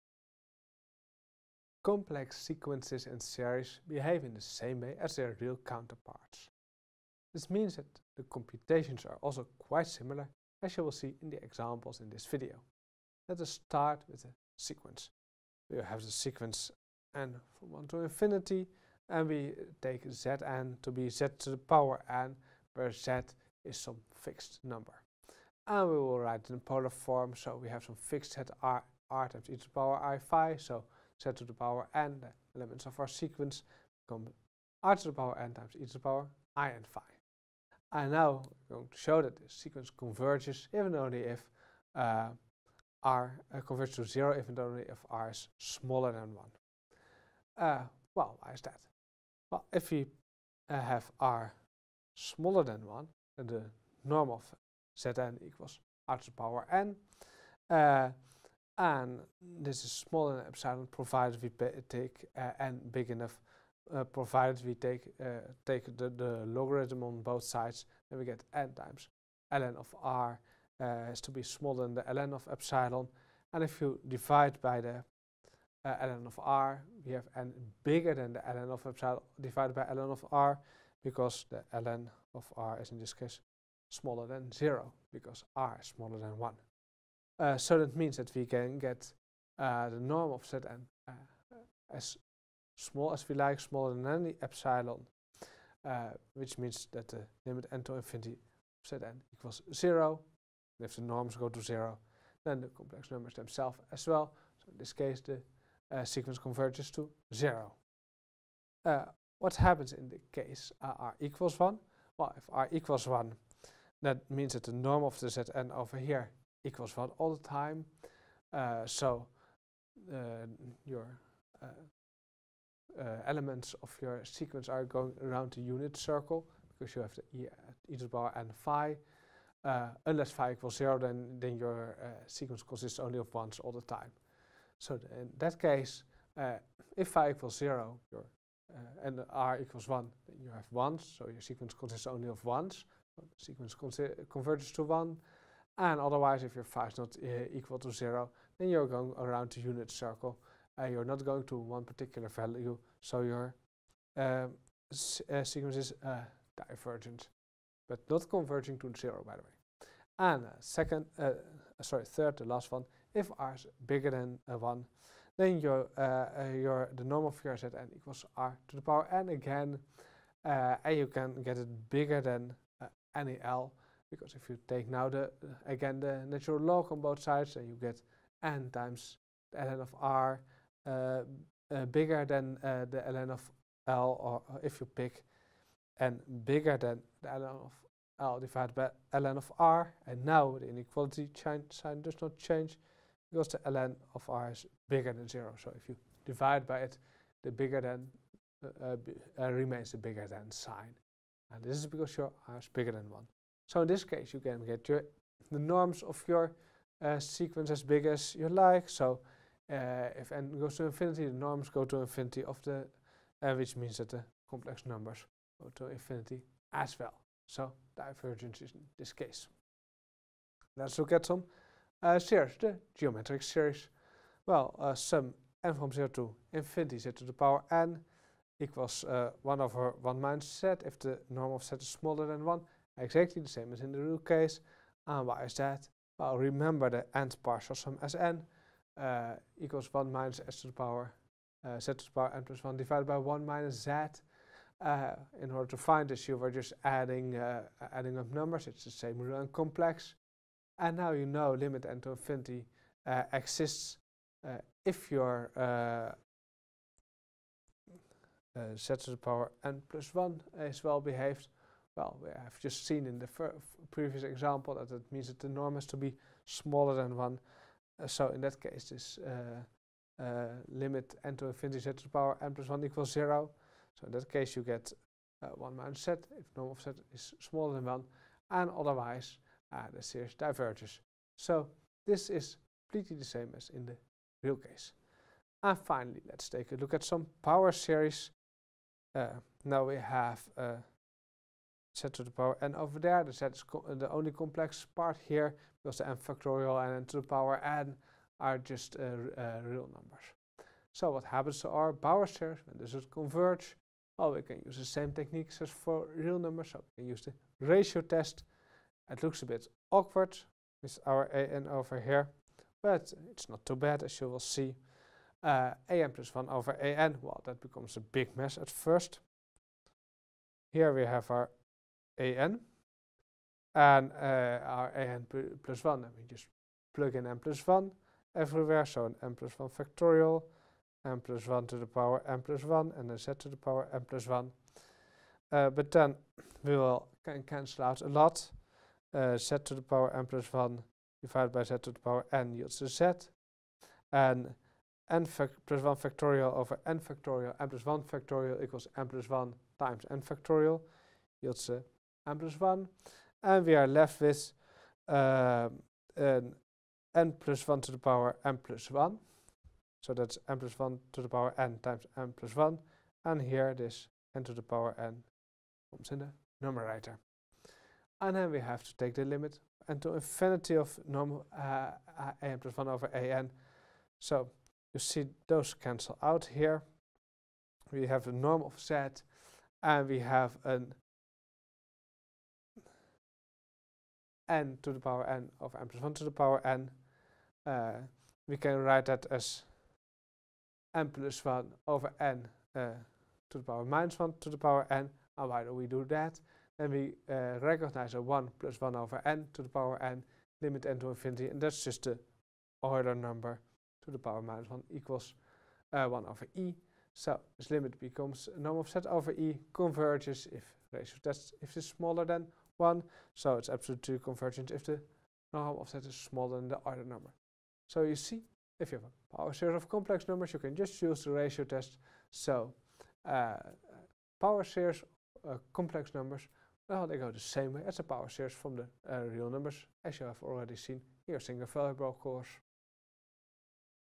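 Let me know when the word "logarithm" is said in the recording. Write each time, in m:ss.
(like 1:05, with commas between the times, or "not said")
1:06.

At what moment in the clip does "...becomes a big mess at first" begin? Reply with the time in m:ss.
5:17.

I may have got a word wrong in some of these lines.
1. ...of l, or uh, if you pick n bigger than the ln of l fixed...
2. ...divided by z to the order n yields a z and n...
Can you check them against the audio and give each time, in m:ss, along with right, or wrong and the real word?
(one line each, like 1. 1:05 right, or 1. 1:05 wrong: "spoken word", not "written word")
1. 3:03 wrong: "divided", not "fixed"
2. 5:41 wrong: "power", not "order".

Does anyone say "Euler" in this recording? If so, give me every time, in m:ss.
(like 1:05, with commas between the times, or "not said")
6:42, 6:56.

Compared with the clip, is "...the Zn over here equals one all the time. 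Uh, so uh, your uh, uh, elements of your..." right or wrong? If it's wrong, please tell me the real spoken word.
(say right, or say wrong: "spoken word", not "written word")
right.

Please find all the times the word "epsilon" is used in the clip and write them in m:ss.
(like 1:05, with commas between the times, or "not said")
1:00, 1:12, 1:18, 1:34.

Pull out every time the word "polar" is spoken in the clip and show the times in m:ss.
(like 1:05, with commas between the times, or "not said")
0:26.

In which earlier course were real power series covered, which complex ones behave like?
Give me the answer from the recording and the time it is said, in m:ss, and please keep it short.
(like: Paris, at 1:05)
single variable course, at 7:11.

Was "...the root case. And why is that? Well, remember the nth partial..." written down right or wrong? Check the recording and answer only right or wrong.
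right.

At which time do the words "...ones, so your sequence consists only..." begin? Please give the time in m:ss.
2:20.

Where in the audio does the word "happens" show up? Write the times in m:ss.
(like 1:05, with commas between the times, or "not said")
1:49, 5:01.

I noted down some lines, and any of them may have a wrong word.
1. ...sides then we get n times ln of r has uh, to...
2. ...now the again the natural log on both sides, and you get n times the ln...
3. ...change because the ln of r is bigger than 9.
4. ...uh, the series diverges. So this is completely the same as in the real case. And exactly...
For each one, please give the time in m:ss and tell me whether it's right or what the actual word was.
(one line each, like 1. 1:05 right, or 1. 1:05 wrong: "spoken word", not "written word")
1. 1:07 right
2. 2:54 right
3. 3:12 wrong: "0", not "9"
4. 4:39 wrong: "finally", not "exactly".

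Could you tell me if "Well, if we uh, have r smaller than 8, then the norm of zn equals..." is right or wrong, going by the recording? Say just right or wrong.
wrong.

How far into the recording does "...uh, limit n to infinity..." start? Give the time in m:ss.
4:30.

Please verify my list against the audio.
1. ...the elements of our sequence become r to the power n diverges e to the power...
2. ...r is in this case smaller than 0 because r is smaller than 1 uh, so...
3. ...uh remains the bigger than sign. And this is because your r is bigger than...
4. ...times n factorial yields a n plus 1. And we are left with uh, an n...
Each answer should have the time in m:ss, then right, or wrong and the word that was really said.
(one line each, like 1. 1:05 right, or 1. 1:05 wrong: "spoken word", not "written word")
1. 0:32 wrong: "times", not "diverges"
2. 1:22 right
3. 3:19 right
4. 5:49 right.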